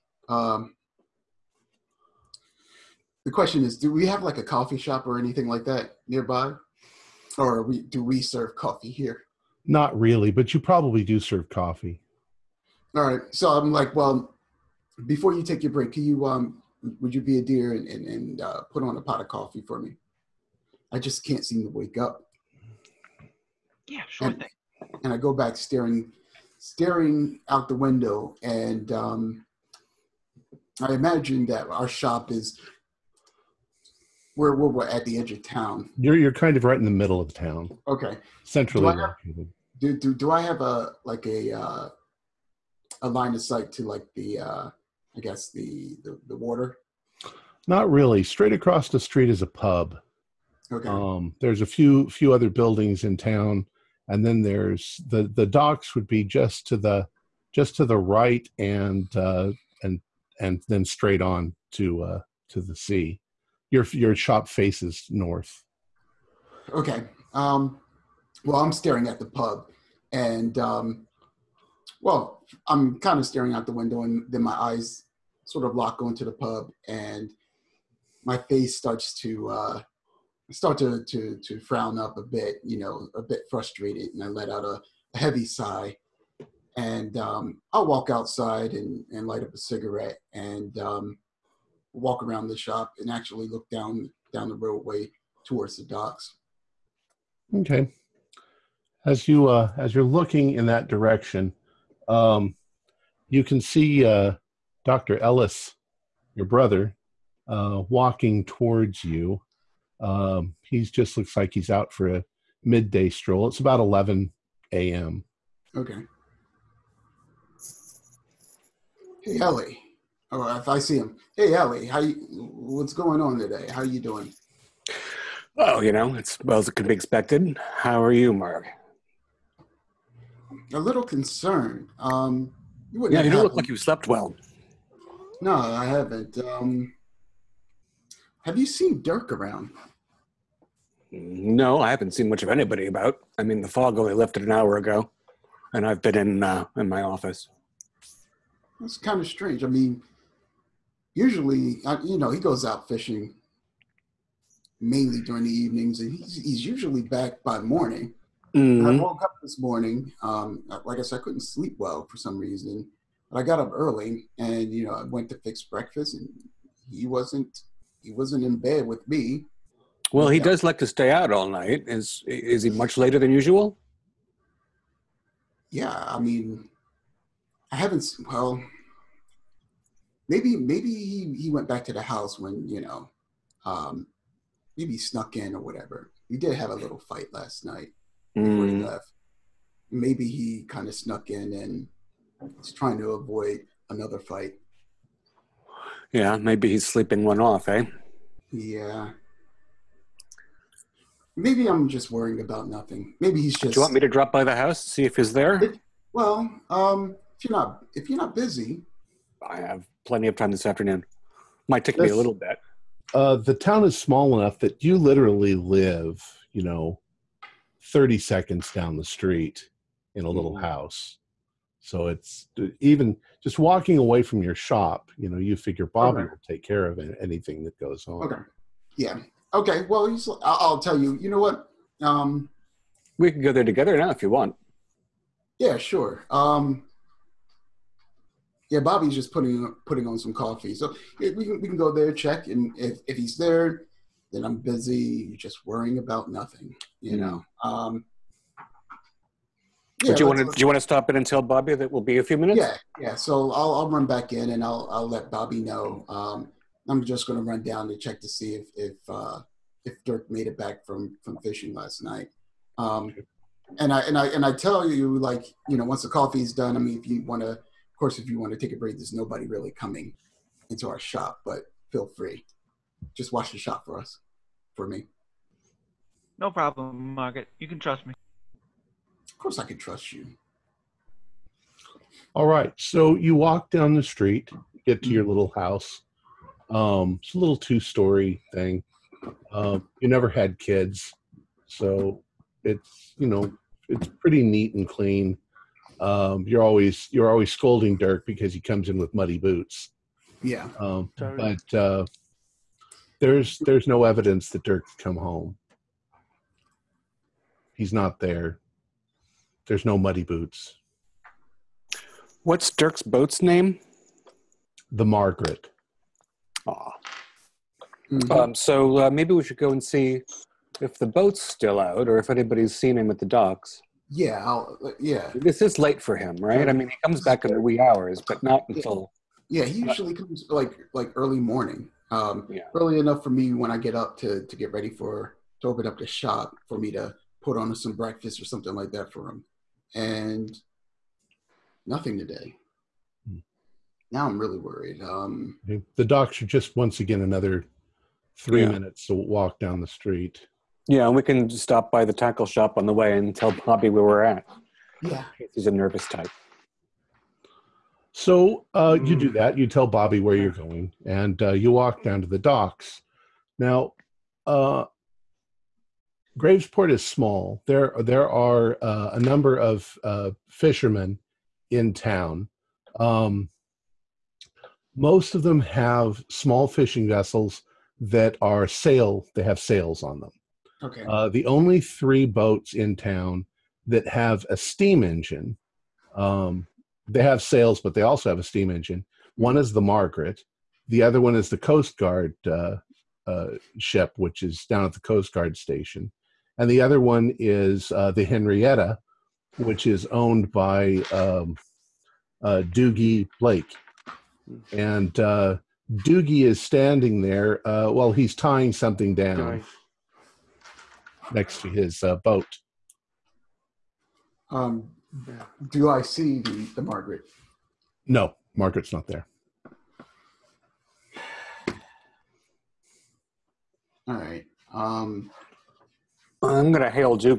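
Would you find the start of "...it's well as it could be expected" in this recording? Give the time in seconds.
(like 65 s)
126 s.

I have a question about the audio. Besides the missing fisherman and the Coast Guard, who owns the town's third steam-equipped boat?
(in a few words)
Doogie Blake.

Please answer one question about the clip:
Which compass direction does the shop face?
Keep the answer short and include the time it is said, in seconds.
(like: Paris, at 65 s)
North, at 65 s.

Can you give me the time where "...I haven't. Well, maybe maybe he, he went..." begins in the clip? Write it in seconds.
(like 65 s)
177 s.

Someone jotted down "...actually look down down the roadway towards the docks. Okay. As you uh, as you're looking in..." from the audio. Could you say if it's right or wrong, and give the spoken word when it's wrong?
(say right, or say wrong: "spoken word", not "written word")
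right.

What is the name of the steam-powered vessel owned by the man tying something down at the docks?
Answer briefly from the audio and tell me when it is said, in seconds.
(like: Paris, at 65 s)
The Henrietta, at 398 s.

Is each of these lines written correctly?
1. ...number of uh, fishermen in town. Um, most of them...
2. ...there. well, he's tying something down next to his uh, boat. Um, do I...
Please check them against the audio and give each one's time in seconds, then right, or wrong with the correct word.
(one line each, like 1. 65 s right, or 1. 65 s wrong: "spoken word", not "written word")
1. 369 s right
2. 407 s right.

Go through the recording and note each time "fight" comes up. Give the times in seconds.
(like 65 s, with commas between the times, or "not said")
186 s, 194 s.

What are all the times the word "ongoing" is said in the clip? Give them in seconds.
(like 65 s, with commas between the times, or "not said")
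not said.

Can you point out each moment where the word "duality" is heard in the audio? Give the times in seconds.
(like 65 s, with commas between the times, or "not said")
not said.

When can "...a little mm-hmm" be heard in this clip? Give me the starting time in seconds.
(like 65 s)
220 s.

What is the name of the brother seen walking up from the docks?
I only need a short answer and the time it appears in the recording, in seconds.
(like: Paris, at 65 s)
Dr. Ellis, at 104 s.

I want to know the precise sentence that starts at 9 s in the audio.
Not really, but you probably do serve coffee.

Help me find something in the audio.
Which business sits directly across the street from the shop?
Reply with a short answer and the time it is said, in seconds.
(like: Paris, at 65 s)
A pub, at 49 s.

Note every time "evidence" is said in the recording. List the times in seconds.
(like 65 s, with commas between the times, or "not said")
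304 s.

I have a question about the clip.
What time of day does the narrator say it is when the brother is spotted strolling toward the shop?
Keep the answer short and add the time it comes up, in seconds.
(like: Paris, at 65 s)
11 a.m., at 113 s.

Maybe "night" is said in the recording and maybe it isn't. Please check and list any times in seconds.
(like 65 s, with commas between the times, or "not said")
171 s, 187 s, 262 s.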